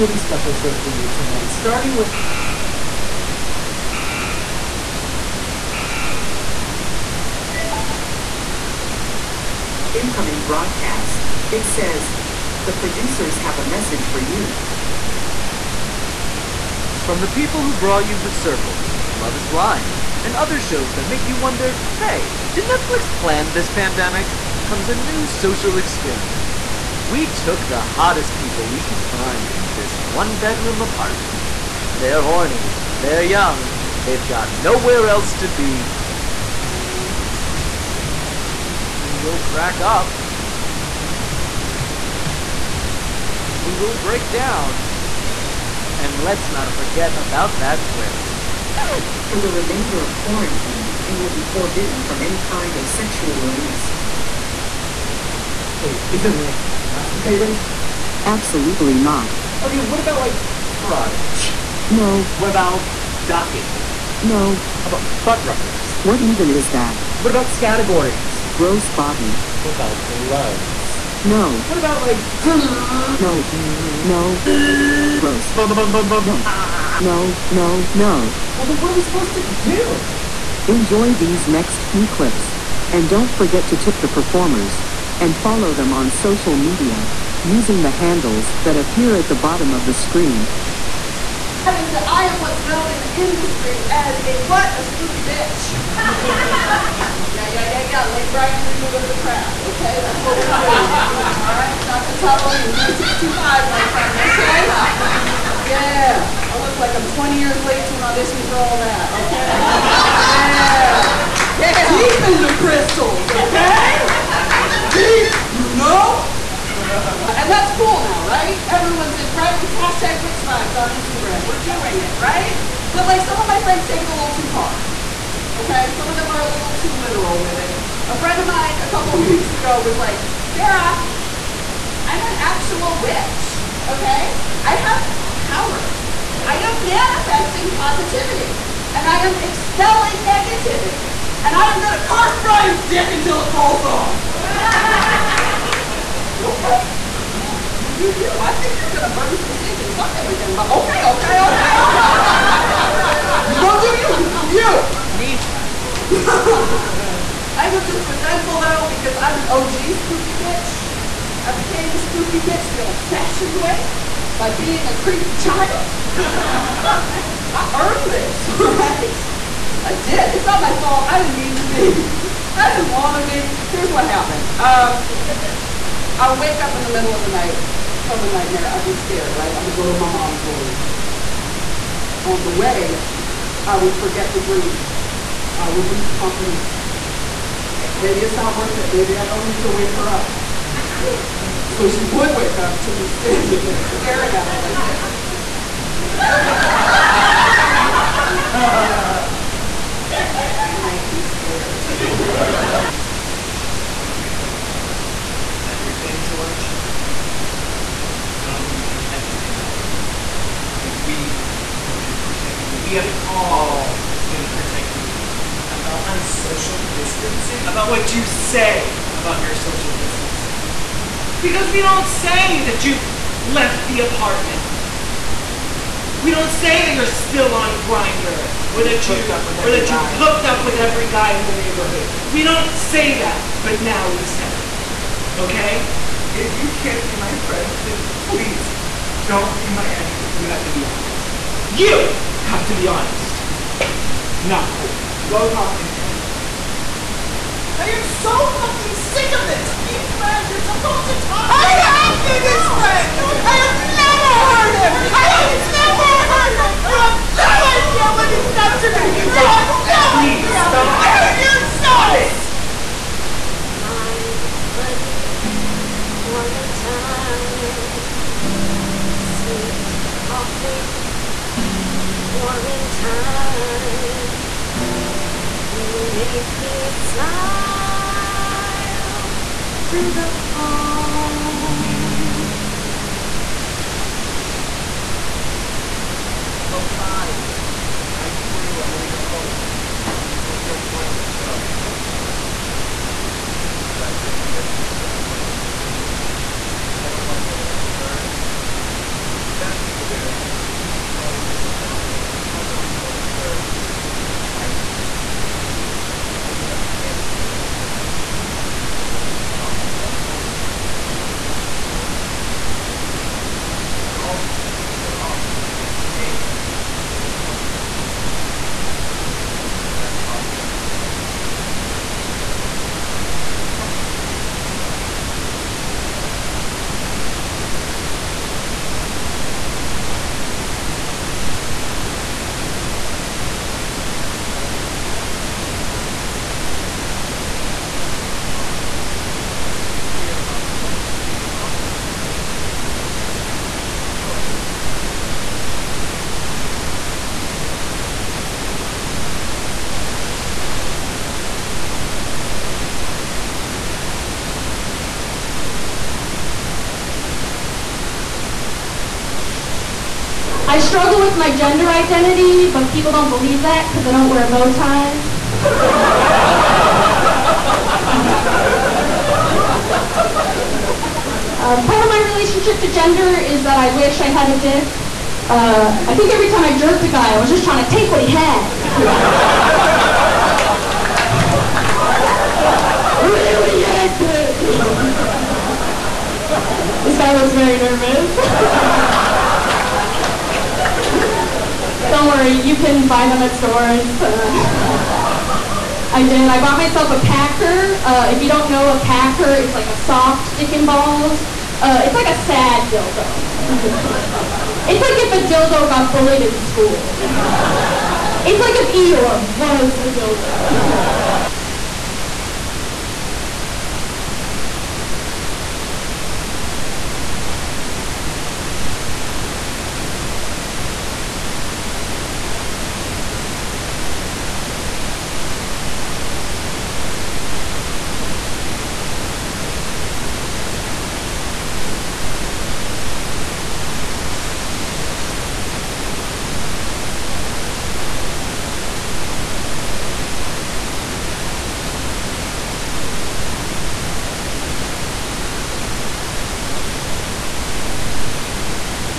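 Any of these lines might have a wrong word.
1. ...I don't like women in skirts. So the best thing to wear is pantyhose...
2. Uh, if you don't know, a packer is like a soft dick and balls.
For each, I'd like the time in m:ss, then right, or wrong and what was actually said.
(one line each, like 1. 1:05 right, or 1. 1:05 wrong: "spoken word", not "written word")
1. 4:57 right
2. 6:38 right.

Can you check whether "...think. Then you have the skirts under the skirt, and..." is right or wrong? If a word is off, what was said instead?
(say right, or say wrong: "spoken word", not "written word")
wrong: "pants", not "skirts".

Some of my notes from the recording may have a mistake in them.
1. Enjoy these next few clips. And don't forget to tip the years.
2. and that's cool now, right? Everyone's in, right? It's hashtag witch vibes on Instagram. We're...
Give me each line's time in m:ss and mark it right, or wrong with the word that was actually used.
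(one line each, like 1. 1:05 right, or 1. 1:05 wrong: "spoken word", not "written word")
1. 1:20 wrong: "performers", not "years"
2. 1:56 right.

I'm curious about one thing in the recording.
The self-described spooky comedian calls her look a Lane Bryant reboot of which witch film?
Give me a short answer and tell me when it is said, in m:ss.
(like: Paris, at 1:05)
The Craft, at 1:39.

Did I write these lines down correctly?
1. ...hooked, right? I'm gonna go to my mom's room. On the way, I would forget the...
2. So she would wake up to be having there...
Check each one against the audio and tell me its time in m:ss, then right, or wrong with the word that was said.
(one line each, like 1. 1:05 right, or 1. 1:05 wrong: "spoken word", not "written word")
1. 2:58 wrong: "scared", not "hooked"
2. 3:11 wrong: "standing", not "having".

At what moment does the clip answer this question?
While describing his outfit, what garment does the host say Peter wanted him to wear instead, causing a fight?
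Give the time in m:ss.
5:29.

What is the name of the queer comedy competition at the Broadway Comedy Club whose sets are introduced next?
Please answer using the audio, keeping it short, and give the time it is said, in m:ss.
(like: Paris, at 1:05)
Yaz Fest, at 5:39.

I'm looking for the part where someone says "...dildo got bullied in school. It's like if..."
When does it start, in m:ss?
6:45.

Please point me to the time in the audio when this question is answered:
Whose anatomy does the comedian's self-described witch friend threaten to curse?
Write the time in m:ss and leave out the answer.
2:22.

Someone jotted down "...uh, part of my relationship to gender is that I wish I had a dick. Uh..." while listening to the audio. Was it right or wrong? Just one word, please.
right.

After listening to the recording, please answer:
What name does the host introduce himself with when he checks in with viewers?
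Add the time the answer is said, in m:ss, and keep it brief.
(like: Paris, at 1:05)
Drew, at 4:48.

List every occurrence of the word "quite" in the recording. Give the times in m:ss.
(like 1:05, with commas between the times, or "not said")
5:29.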